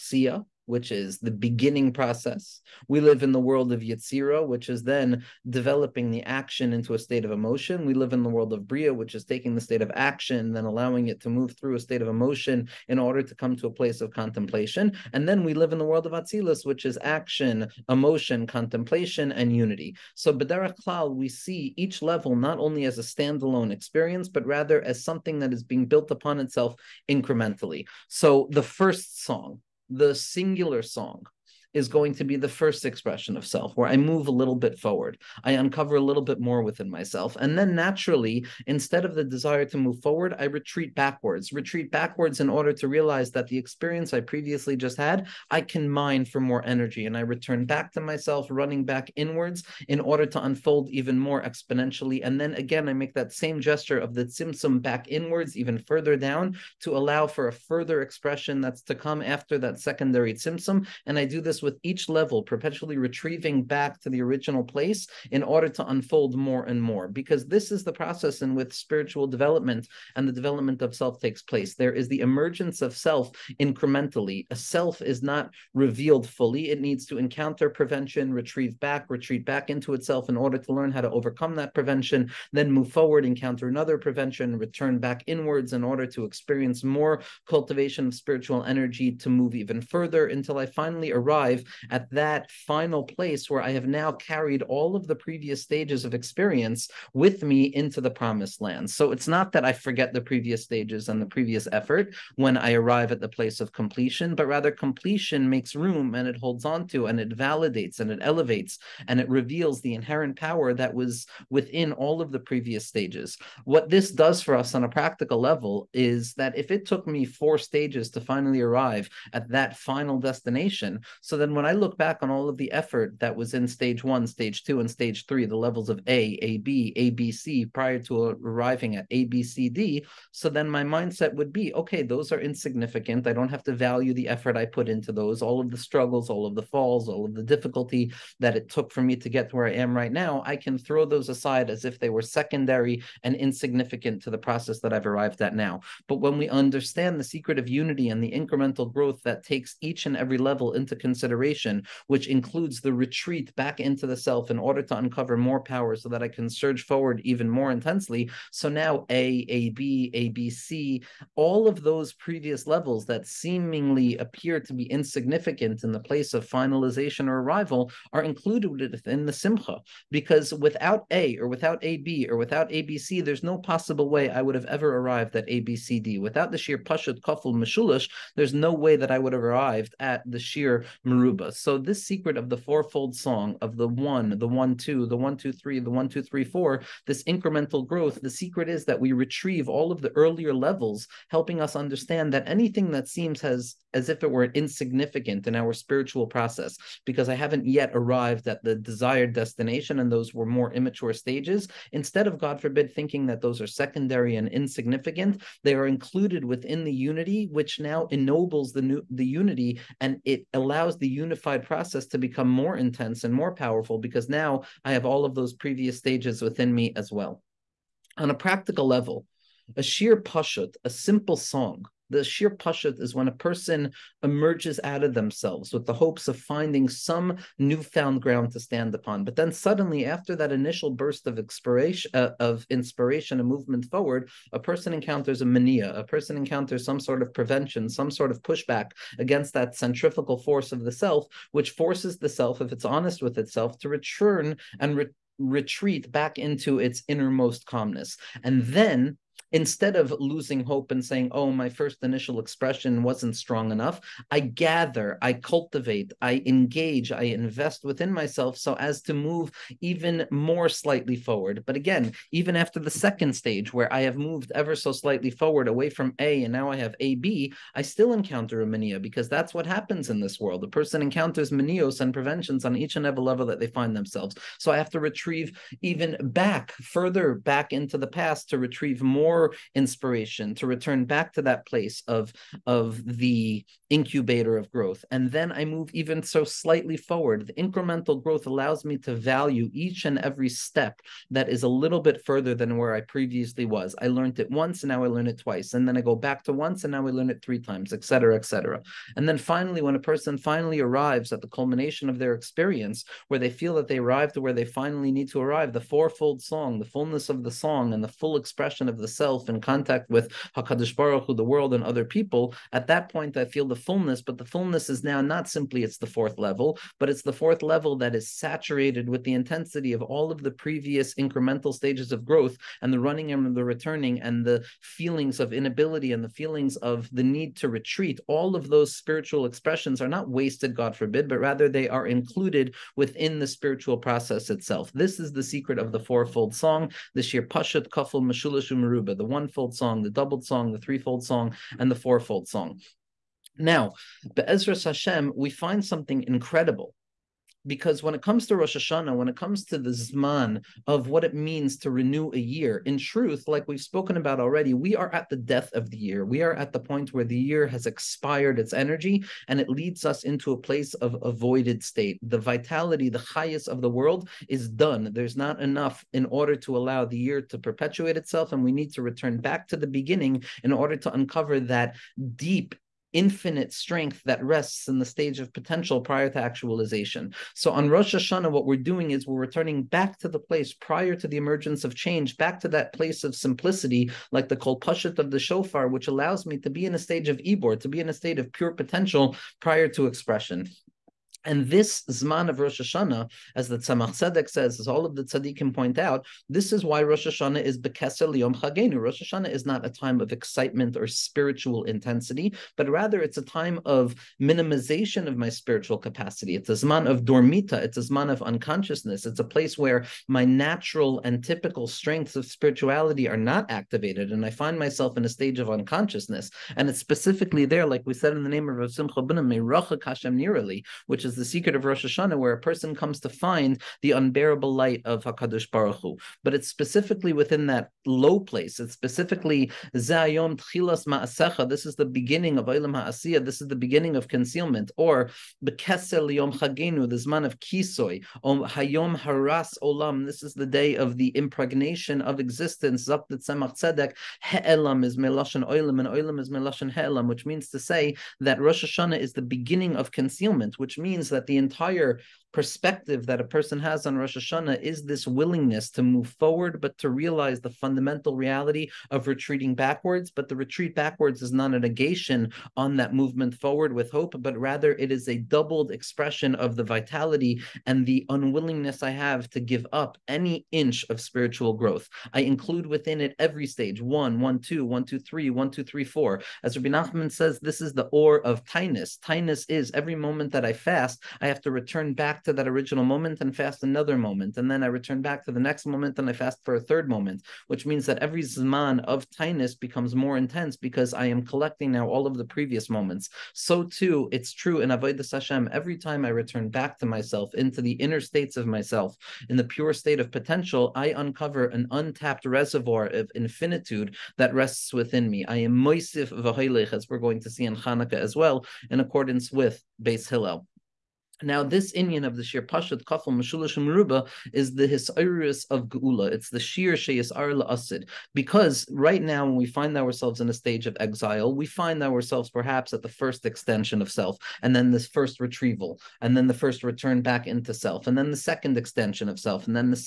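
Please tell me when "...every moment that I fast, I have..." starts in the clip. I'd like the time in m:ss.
7:59.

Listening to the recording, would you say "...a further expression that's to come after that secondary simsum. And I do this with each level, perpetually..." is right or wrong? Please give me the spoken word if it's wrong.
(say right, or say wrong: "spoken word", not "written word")
right.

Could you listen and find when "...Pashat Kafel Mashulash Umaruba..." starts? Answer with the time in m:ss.
5:37.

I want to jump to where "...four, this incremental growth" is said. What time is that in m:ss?
3:06.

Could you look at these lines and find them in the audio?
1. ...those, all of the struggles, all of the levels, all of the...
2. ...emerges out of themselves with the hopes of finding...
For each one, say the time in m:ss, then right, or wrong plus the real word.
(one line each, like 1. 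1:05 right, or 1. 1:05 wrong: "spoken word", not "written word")
1. 2:15 wrong: "falls", not "levels"
2. 3:44 right.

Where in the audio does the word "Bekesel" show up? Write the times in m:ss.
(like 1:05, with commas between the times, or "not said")
6:37, 7:15.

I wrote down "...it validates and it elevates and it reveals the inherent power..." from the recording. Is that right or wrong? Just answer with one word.
right.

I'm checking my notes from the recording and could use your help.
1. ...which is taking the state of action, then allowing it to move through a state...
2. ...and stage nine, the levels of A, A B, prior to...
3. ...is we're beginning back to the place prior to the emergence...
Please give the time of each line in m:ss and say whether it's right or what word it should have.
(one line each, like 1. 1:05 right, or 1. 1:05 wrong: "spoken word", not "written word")
1. 0:08 right
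2. 2:04 wrong: "three", not "nine"
3. 6:19 wrong: "returning", not "beginning".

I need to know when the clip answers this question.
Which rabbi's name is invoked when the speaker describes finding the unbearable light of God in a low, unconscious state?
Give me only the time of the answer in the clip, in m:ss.
6:58.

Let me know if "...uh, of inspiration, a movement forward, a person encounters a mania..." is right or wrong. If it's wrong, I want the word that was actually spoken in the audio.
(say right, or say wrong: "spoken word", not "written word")
right.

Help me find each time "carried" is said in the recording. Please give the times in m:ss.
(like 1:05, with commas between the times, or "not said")
1:34.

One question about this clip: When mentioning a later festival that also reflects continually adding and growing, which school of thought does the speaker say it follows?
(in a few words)
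Beis Hillel.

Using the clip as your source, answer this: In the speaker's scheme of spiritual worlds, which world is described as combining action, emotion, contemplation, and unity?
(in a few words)
Atzilus.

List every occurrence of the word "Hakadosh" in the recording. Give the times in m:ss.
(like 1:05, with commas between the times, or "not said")
5:10, 7:05.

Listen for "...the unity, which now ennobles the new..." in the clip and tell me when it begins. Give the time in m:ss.
3:26.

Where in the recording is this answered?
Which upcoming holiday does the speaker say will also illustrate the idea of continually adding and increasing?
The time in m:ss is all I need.
8:27.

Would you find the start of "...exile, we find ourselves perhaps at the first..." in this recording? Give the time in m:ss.
8:40.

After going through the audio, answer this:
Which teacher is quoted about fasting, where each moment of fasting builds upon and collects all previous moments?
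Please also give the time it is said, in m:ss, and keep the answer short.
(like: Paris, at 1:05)
Rabbi Nachman, at 7:56.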